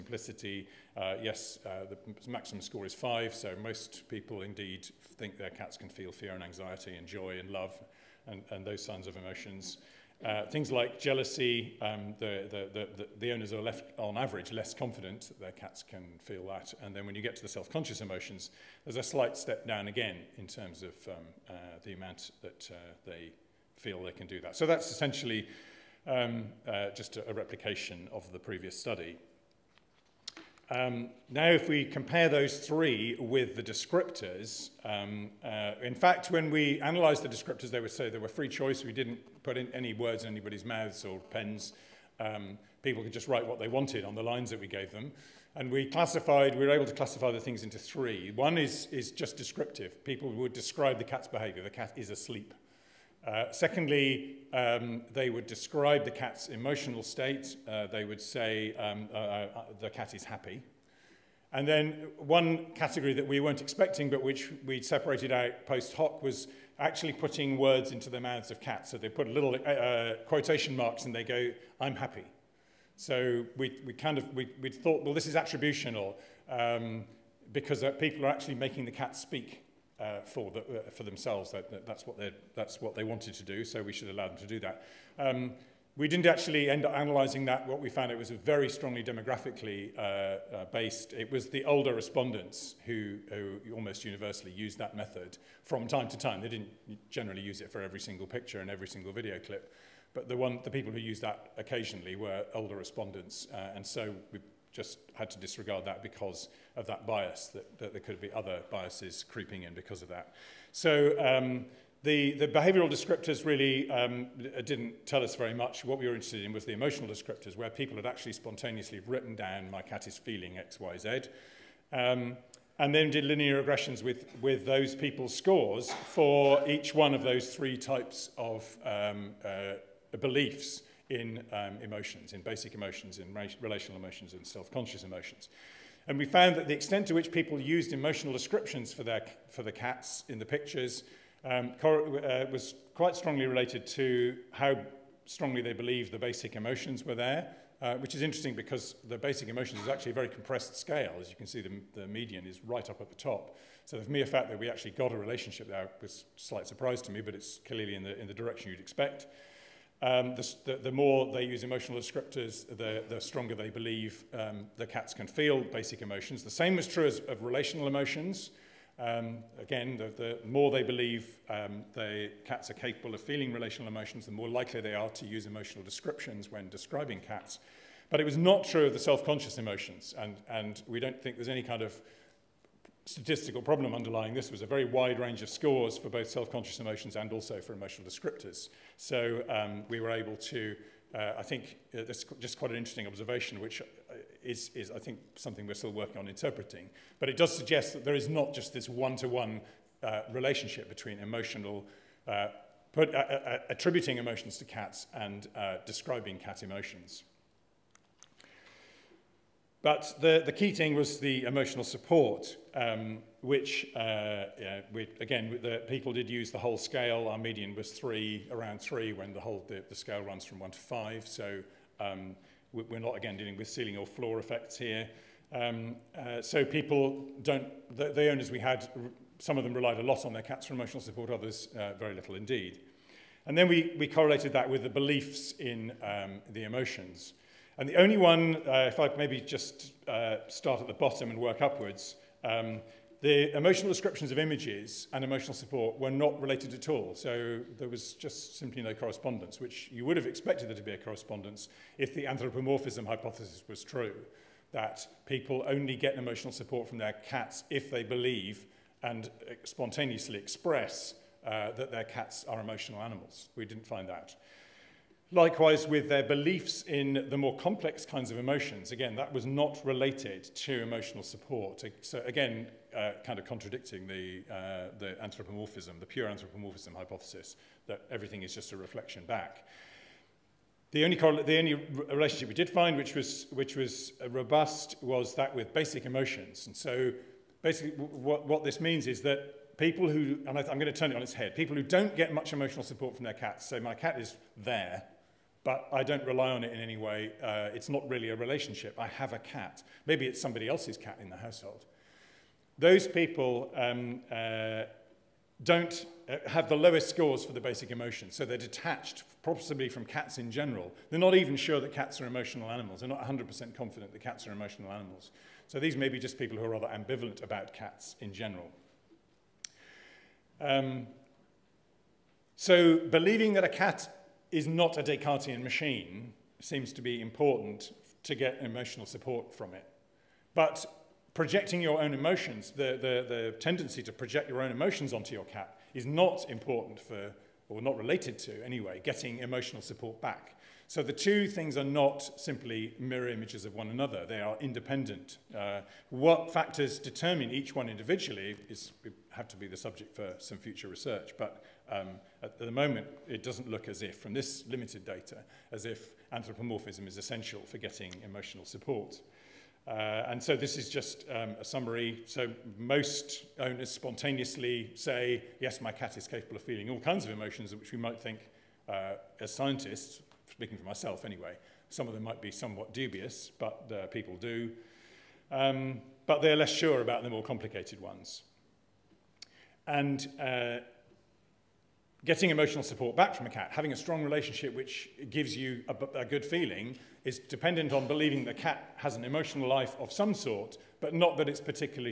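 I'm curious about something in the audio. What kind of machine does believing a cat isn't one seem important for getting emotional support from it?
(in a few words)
Descartesian.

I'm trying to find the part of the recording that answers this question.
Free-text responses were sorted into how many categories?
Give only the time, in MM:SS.
00:46.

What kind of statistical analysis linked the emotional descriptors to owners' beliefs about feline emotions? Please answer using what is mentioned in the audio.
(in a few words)
linear regressions.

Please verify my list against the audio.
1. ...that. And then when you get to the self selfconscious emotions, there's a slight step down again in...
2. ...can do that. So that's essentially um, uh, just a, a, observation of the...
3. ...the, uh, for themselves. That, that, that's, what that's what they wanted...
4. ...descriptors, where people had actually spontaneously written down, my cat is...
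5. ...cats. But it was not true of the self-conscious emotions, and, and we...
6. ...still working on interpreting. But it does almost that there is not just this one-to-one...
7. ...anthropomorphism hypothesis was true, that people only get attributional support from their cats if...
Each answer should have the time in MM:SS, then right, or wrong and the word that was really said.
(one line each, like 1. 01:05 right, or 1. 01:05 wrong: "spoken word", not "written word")
1. 00:16 wrong: "conscious", not "selfconscious"
2. 00:24 wrong: "replication", not "observation"
3. 01:20 right
4. 01:57 right
5. 02:57 right
6. 03:15 wrong: "suggest", not "almost"
7. 04:12 wrong: "emotional", not "attributional".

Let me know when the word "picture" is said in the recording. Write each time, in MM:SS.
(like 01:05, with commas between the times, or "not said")
01:38, 02:20.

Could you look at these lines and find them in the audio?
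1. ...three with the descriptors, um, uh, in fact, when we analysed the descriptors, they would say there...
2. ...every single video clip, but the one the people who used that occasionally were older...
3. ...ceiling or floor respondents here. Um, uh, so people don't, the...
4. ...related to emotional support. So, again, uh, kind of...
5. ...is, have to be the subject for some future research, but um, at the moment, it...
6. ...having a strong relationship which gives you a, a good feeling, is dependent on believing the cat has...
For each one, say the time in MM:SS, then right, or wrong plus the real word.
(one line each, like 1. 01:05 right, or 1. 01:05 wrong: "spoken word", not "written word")
1. 00:32 right
2. 01:38 right
3. 03:43 wrong: "effects", not "respondents"
4. 04:29 right
5. 05:48 right
6. 06:23 right.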